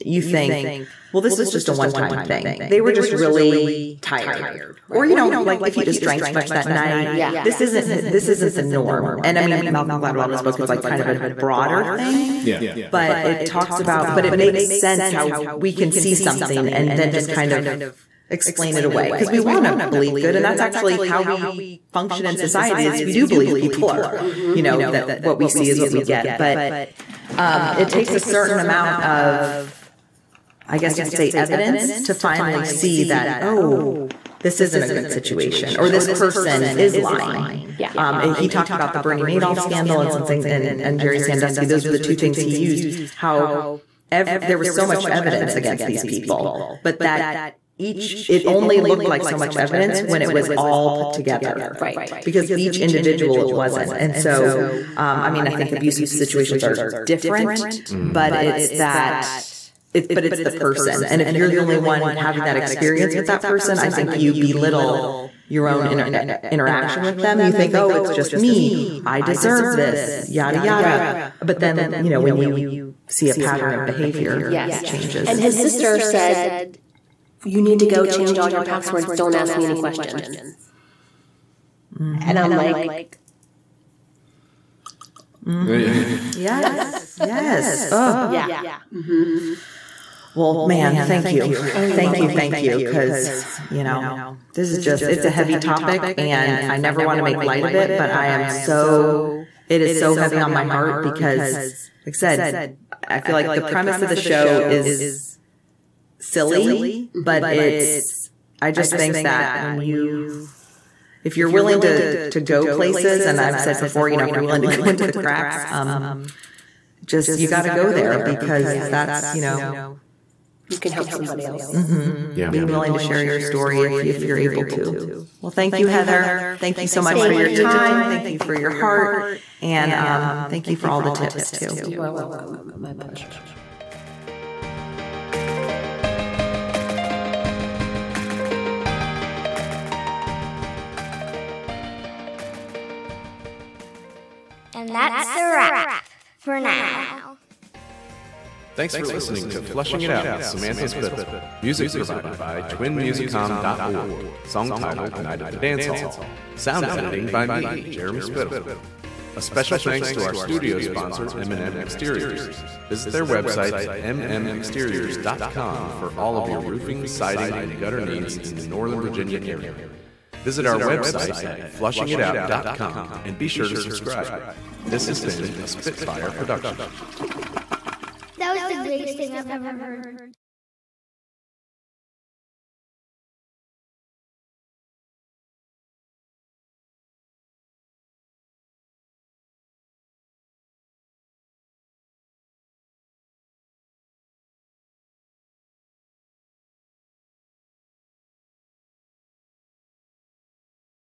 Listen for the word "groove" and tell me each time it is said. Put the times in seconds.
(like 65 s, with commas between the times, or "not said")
not said.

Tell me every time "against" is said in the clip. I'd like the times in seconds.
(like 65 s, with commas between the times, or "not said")
45 s.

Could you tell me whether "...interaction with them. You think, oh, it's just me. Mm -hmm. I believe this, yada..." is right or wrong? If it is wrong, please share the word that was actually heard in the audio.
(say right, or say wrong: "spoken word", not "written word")
wrong: "deserve", not "believe".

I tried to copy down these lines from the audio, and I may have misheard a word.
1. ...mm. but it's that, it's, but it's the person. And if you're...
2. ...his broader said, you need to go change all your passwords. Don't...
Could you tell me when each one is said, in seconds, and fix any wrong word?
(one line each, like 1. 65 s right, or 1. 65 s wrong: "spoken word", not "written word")
1. 57 s right
2. 75 s wrong: "sister", not "broader".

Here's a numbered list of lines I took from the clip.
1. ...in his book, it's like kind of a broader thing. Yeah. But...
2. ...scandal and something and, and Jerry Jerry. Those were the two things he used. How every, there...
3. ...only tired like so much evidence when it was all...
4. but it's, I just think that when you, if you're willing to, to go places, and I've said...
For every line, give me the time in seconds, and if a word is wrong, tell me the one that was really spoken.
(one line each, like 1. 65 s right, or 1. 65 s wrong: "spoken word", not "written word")
1. 10 s right
2. 39 s wrong: "Sandusky", not "Jerry"
3. 48 s wrong: "looked", not "tired"
4. 107 s right.